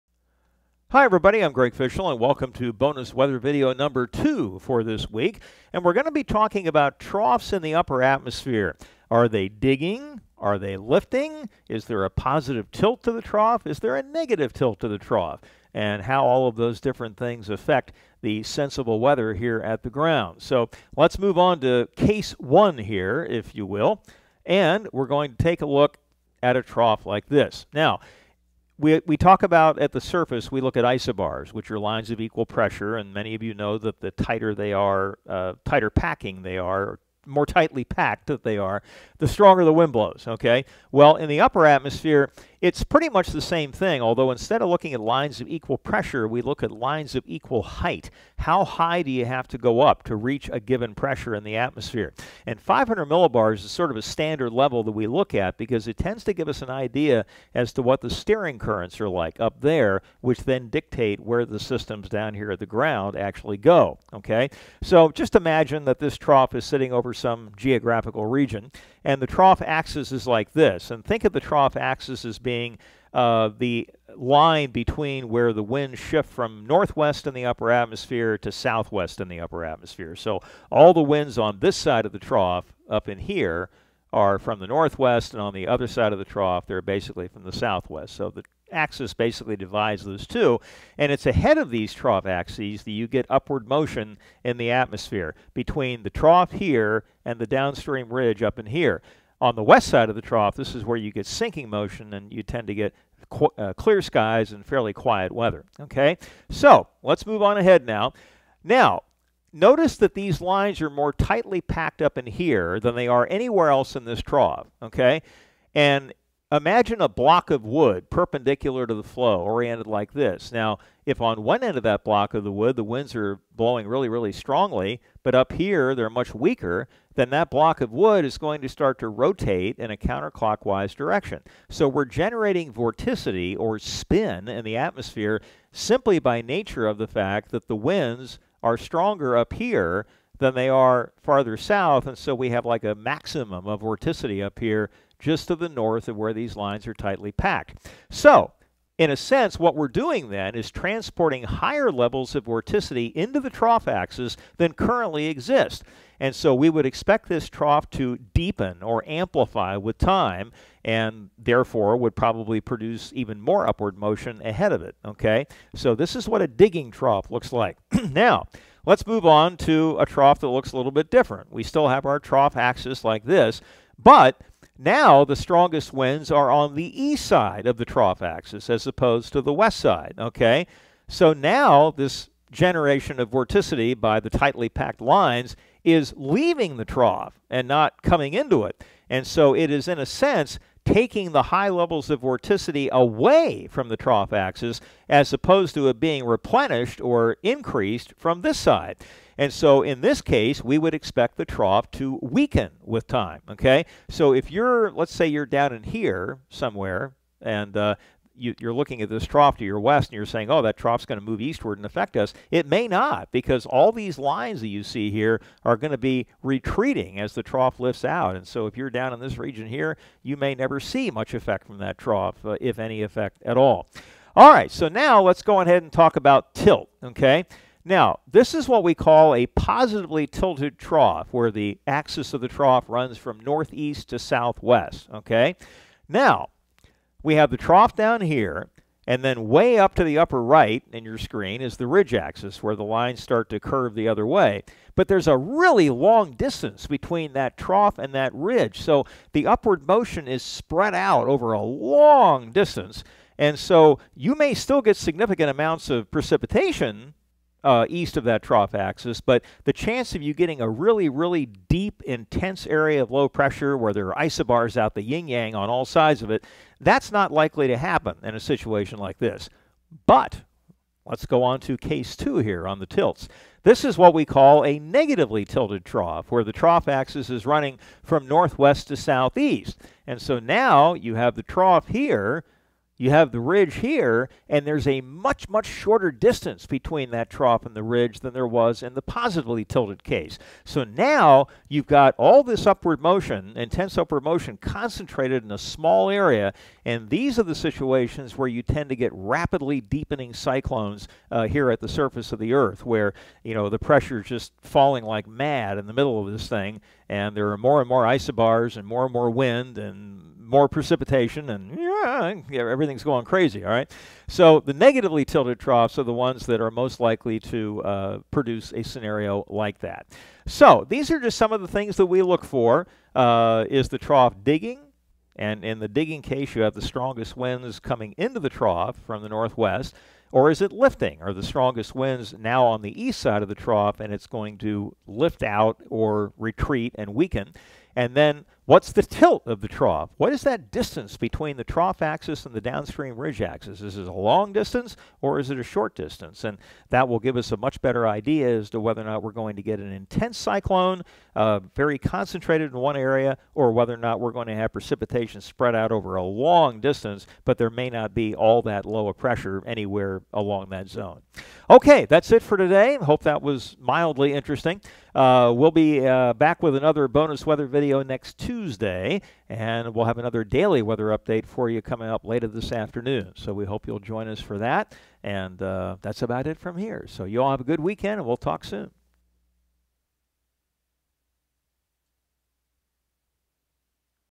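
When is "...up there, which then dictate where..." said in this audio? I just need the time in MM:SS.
00:59.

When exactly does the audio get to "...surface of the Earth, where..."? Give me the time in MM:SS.
05:01.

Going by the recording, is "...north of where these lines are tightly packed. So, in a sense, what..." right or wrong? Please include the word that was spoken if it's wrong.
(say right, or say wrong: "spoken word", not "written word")
right.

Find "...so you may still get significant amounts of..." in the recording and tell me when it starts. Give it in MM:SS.
04:13.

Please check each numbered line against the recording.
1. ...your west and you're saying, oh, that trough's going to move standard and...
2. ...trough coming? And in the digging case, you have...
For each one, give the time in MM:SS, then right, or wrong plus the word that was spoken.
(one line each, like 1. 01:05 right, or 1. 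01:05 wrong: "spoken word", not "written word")
1. 03:29 wrong: "eastward", not "standard"
2. 05:23 wrong: "digging", not "coming".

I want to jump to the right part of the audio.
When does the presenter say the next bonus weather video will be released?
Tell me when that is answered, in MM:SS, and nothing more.
06:08.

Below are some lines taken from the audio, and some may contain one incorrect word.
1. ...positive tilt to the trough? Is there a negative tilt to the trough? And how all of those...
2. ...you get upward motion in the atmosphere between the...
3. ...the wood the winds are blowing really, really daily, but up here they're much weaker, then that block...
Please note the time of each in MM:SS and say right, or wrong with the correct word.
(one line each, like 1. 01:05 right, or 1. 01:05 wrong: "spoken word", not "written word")
1. 00:12 right
2. 01:32 right
3. 02:02 wrong: "strongly", not "daily".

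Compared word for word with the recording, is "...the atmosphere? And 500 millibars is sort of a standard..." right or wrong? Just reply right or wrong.
right.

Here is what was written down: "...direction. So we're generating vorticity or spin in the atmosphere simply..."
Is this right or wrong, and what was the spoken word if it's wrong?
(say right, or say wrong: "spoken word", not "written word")
right.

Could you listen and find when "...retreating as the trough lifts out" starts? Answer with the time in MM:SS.
03:36.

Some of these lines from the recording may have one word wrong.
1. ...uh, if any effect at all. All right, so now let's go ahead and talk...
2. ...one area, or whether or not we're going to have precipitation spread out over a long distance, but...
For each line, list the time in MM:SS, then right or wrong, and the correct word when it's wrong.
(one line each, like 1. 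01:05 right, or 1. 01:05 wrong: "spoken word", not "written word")
1. 03:42 right
2. 05:52 right.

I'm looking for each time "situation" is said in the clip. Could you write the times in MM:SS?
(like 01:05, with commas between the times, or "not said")
04:28, 04:57.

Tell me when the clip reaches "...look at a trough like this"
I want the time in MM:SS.
00:25.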